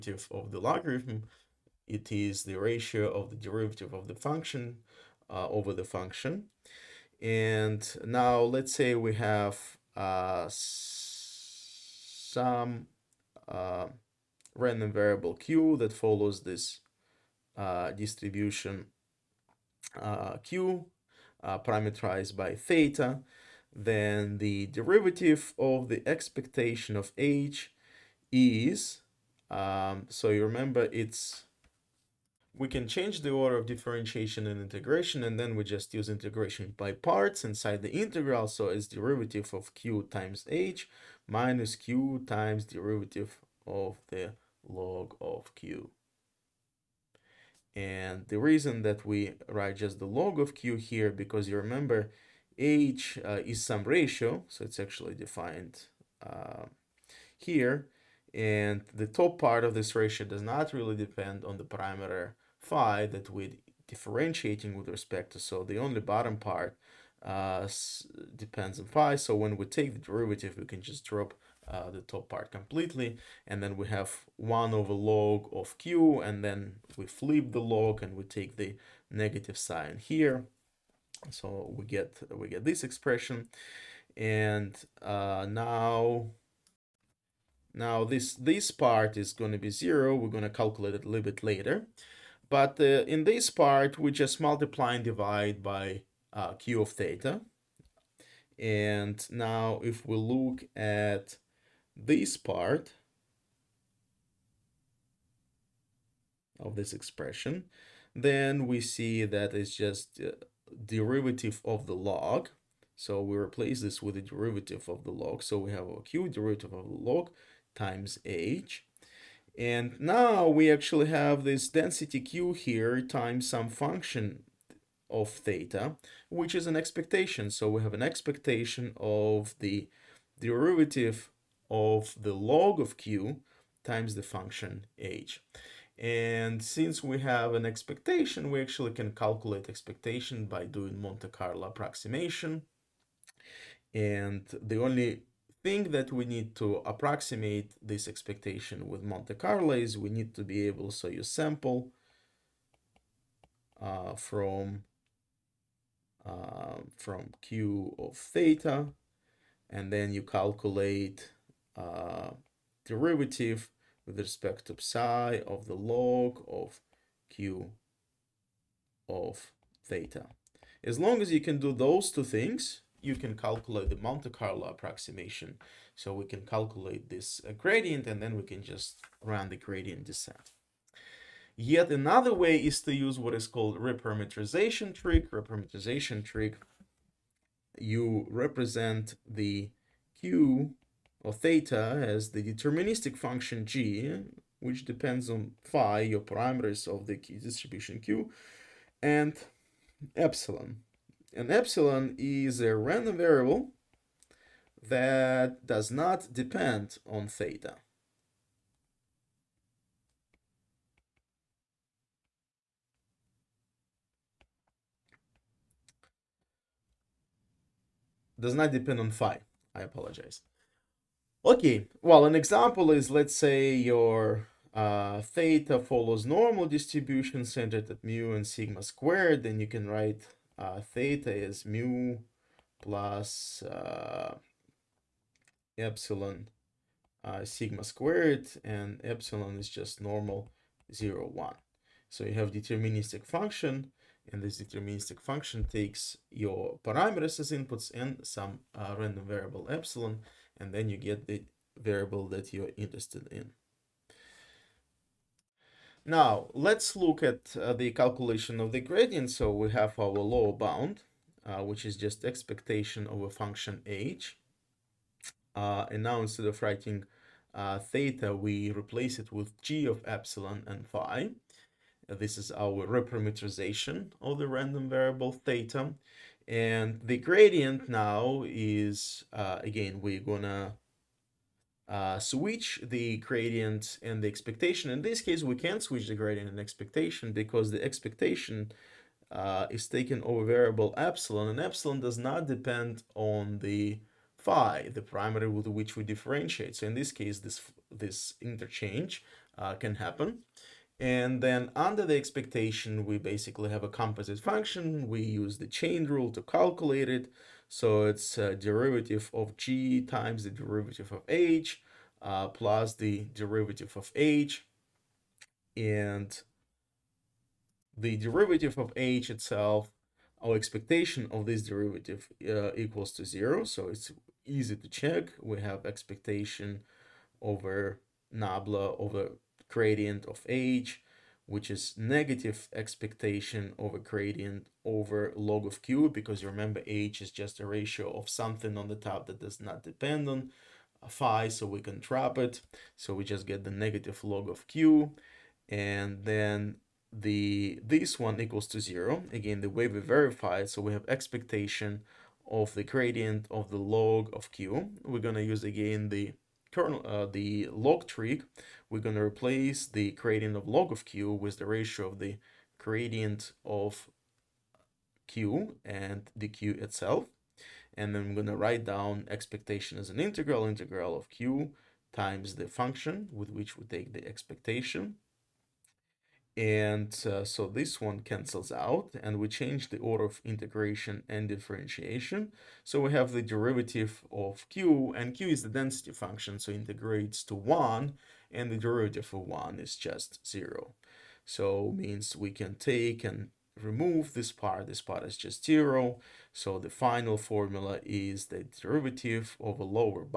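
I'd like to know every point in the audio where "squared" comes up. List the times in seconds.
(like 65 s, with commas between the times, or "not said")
228 s, 237 s.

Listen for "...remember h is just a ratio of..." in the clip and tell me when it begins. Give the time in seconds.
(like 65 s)
336 s.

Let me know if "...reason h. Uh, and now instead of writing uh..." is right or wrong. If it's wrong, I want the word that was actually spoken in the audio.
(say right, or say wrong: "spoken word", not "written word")
wrong: "function", not "reason".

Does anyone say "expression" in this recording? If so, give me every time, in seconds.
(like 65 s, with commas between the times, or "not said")
82 s, 106 s.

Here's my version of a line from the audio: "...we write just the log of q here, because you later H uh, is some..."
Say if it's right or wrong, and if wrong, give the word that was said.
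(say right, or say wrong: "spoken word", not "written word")
wrong: "remember", not "later".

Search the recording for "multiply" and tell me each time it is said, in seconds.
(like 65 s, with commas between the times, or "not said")
94 s.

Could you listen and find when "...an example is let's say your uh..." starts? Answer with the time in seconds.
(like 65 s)
222 s.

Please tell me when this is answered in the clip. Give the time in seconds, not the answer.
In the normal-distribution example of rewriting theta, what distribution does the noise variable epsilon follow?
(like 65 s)
240 s.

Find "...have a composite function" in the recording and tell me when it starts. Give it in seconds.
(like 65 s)
303 s.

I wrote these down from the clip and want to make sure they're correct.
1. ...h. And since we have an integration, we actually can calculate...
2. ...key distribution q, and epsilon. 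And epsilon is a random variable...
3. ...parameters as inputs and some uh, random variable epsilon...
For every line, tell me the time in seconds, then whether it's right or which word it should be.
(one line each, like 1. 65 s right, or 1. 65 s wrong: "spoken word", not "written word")
1. 134 s wrong: "expectation", not "integration"
2. 197 s right
3. 246 s right.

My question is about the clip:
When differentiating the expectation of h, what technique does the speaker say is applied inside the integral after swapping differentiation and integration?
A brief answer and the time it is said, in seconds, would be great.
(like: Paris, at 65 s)
integration by parts, at 36 s.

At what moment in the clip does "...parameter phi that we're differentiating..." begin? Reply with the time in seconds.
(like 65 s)
61 s.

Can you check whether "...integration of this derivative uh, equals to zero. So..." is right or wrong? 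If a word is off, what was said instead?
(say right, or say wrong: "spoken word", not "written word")
wrong: "expectation", not "integration".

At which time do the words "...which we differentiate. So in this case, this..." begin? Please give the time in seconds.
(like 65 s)
295 s.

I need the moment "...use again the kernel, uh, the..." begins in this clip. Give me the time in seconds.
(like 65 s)
355 s.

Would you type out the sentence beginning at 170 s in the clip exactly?
As long as you can do those two things, you can calculate the Monte Carlo approximation.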